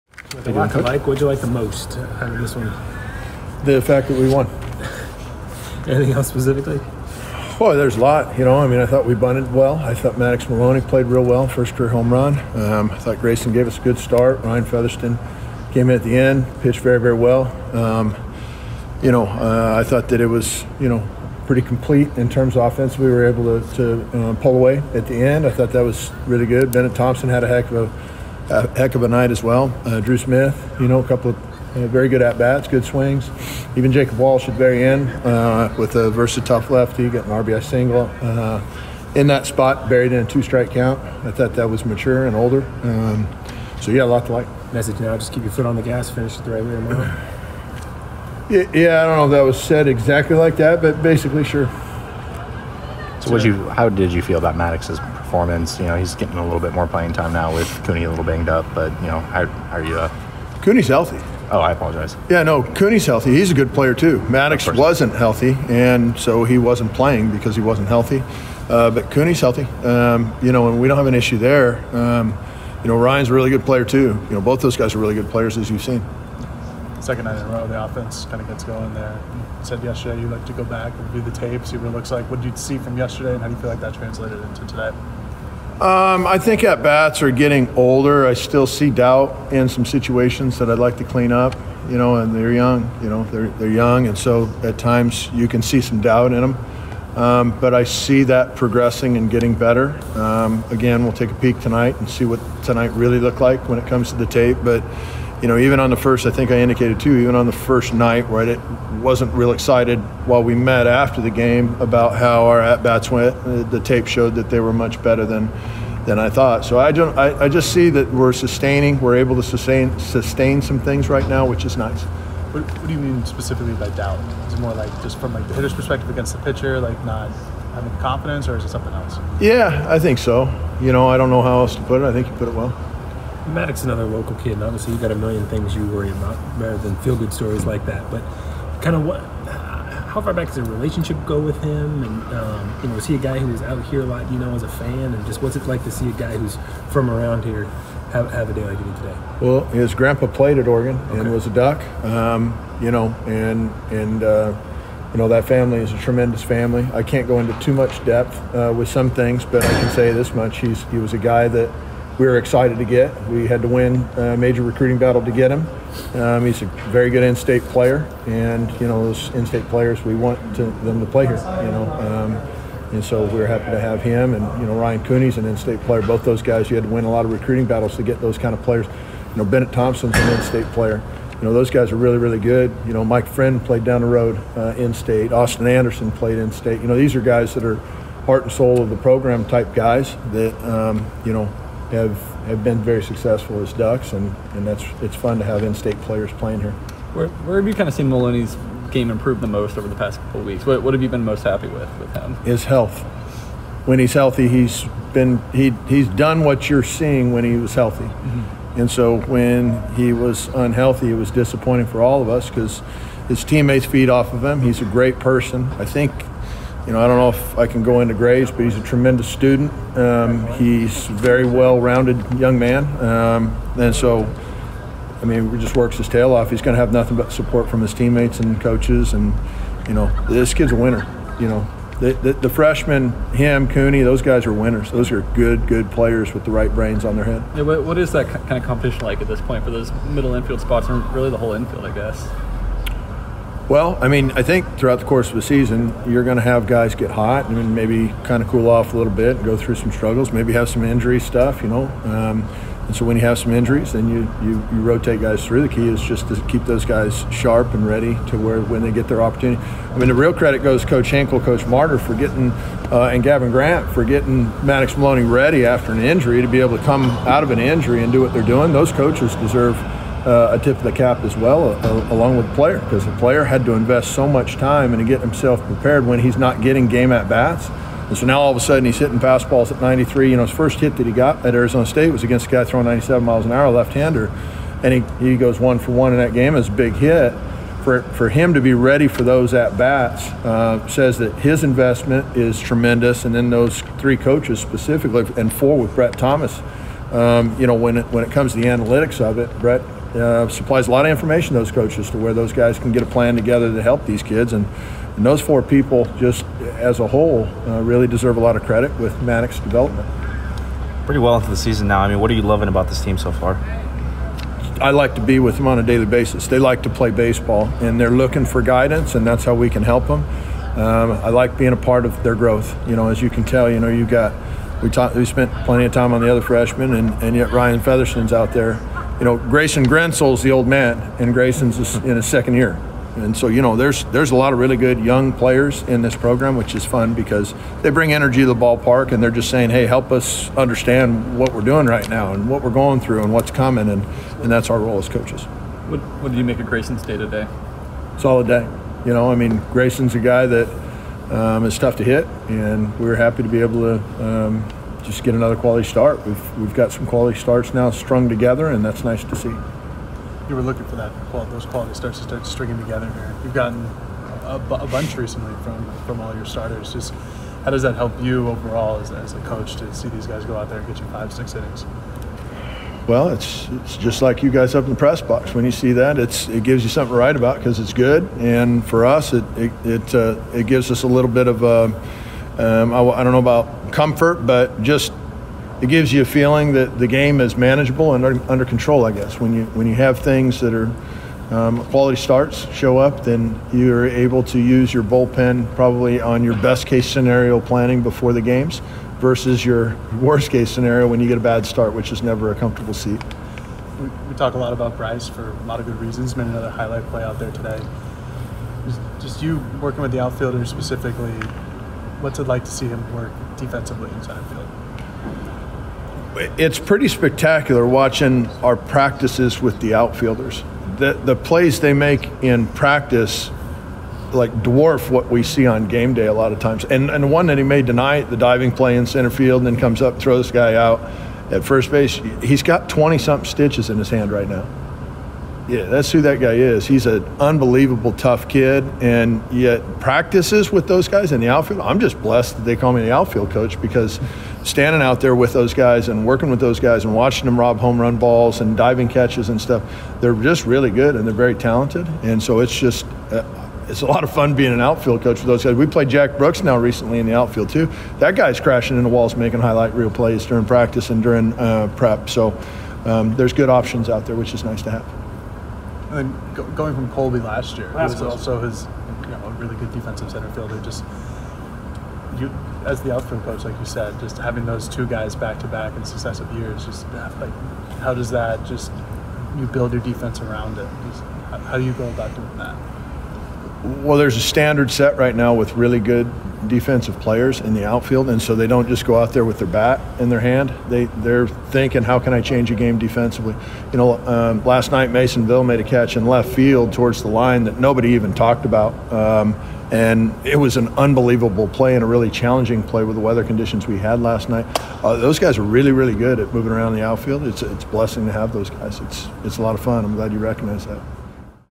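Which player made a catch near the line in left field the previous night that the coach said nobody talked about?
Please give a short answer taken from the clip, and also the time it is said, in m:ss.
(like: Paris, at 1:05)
Mason Neville, at 8:15.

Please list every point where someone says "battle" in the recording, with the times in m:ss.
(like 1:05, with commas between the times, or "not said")
2:44, 2:57.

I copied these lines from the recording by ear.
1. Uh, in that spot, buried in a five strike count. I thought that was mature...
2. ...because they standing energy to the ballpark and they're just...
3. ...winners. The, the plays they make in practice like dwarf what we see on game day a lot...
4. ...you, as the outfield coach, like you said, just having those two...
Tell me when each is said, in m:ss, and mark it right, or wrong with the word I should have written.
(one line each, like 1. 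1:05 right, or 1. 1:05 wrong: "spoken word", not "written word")
1. 0:38 wrong: "two", not "five"
2. 5:37 wrong: "bring", not "standing"
3. 6:59 wrong: "outfielders", not "winners"
4. 7:52 right.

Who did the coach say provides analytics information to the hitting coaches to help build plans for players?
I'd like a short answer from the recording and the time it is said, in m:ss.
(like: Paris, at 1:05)
Brett Thomas, at 4:55.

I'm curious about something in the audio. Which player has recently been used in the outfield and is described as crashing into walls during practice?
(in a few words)
Jack Brooks.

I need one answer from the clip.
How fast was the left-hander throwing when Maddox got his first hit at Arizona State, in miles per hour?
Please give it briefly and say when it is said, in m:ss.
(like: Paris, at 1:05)
97, at 4:42.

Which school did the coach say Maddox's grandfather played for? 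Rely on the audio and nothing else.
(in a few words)
Oregon.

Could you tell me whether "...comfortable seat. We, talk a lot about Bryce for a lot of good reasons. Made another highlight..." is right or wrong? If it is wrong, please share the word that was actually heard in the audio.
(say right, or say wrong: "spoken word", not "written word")
right.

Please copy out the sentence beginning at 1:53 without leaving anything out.
Uh, the, tape showed that they were much better than than I thought.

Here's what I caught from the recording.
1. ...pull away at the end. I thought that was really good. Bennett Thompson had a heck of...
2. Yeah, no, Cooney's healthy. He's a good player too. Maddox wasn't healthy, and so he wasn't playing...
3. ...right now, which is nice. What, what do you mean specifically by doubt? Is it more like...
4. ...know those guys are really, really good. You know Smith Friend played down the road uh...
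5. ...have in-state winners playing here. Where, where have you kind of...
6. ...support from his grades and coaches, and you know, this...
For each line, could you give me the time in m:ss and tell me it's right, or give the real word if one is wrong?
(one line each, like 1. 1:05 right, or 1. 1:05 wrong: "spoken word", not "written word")
1. 0:24 right
2. 1:02 right
3. 2:01 right
4. 3:01 wrong: "Mike", not "Smith"
5. 3:15 wrong: "players", not "winners"
6. 3:47 wrong: "teammates", not "grades".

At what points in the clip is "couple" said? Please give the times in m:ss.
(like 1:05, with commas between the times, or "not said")
0:31, 3:20.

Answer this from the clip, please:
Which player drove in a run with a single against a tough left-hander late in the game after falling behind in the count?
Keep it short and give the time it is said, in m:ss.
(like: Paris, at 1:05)
Jacob Walsh, at 0:33.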